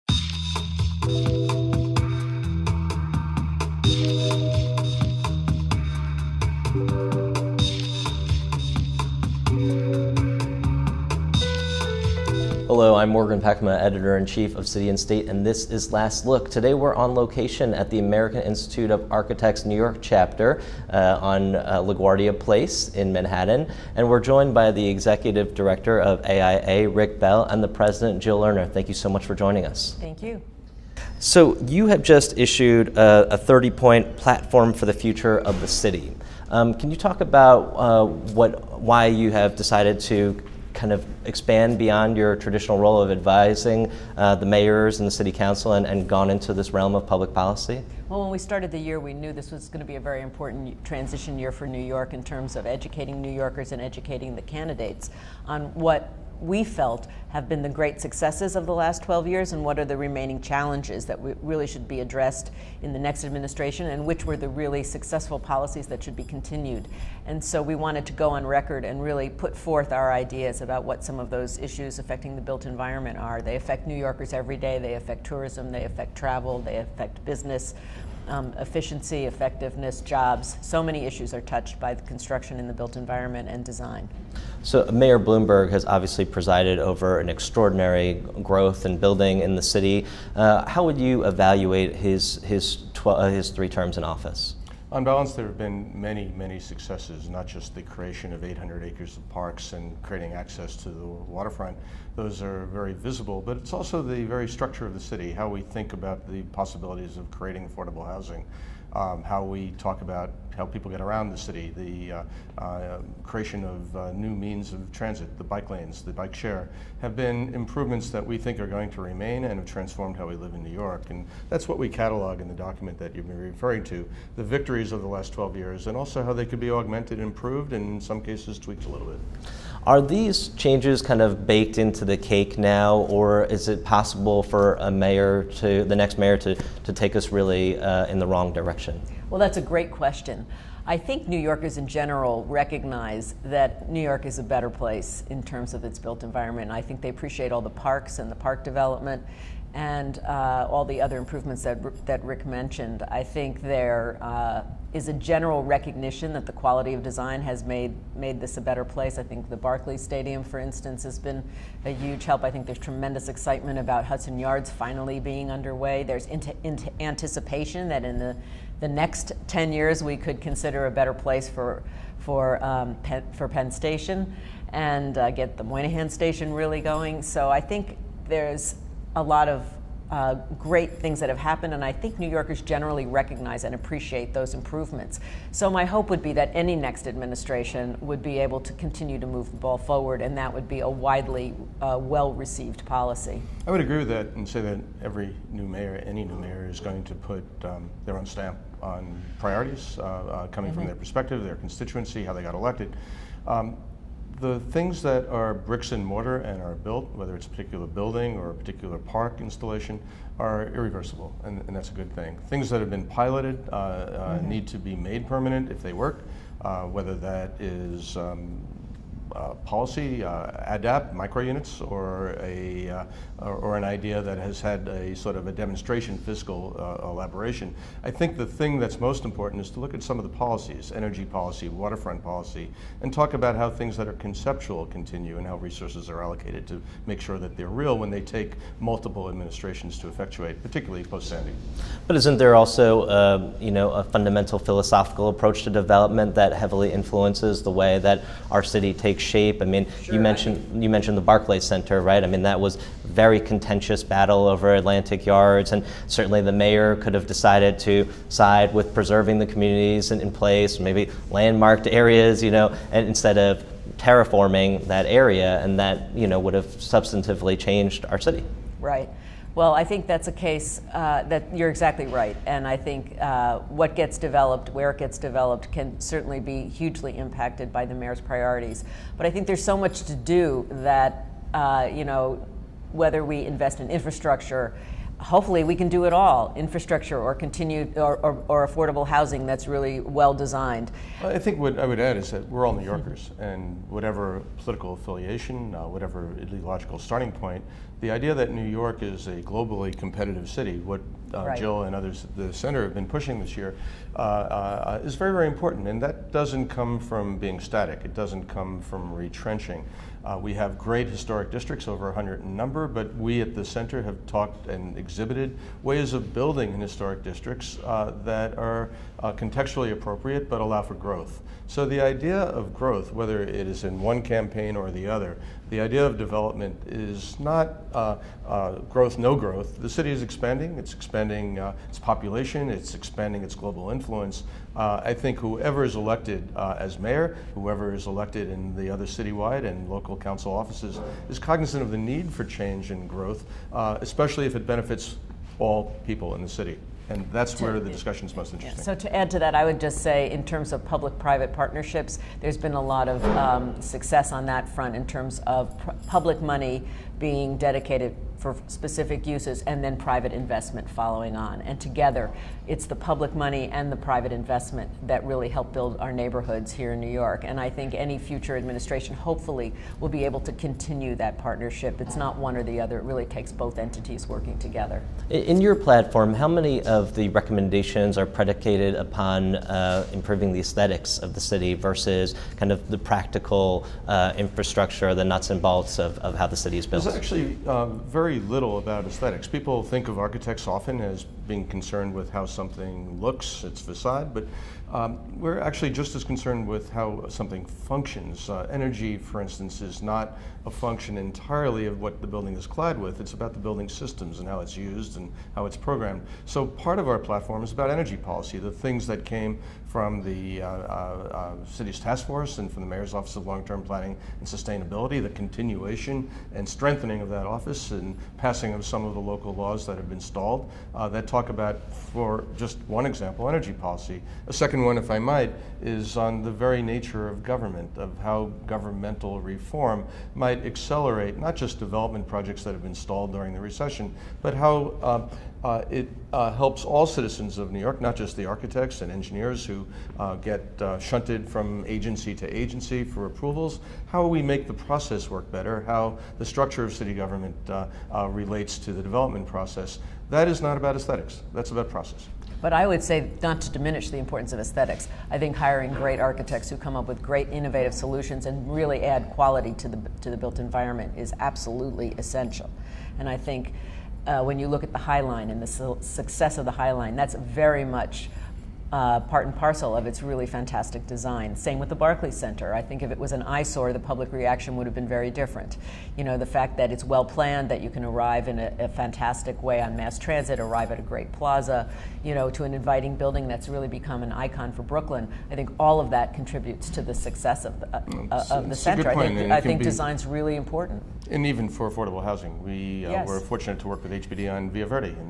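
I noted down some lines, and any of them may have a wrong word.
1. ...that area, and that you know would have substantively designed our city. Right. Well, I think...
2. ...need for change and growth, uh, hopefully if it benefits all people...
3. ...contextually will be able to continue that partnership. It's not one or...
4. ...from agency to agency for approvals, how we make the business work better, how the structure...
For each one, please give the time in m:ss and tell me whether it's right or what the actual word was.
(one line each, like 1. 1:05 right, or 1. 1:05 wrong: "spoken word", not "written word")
1. 4:24 wrong: "changed", not "designed"
2. 5:41 wrong: "especially", not "hopefully"
3. 6:09 wrong: "hopefully", not "contextually"
4. 7:21 wrong: "process", not "business".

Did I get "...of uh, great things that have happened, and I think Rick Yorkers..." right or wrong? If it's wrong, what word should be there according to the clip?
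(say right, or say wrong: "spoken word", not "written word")
wrong: "New", not "Rick".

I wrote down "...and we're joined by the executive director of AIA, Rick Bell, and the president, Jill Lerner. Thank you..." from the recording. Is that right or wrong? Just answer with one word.
right.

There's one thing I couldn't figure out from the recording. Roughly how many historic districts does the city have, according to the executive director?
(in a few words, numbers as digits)
over 100.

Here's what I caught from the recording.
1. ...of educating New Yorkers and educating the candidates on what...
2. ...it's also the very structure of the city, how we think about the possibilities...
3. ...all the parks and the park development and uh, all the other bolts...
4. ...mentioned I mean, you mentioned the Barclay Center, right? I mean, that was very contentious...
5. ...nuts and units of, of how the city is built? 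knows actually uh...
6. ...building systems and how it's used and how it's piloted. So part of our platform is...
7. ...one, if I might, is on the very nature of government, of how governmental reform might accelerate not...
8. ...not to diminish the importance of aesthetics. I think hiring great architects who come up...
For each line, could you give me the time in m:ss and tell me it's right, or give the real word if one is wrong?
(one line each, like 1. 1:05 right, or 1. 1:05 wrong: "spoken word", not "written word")
1. 0:52 right
2. 1:43 right
3. 2:27 wrong: "improvements", not "bolts"
4. 4:10 right
5. 6:25 wrong: "bolts", not "units"
6. 6:43 wrong: "programmed", not "piloted"
7. 7:04 right
8. 7:33 right.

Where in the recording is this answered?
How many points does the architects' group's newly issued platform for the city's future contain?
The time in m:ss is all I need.
0:33.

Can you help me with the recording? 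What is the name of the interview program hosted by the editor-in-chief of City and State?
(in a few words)
Last Look.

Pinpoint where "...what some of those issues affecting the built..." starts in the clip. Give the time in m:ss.
1:10.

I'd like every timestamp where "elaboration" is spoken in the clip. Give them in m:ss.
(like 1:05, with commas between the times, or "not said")
3:47.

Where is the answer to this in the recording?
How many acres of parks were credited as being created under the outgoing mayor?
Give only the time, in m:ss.
1:38.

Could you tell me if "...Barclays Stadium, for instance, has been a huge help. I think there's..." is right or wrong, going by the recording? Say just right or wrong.
right.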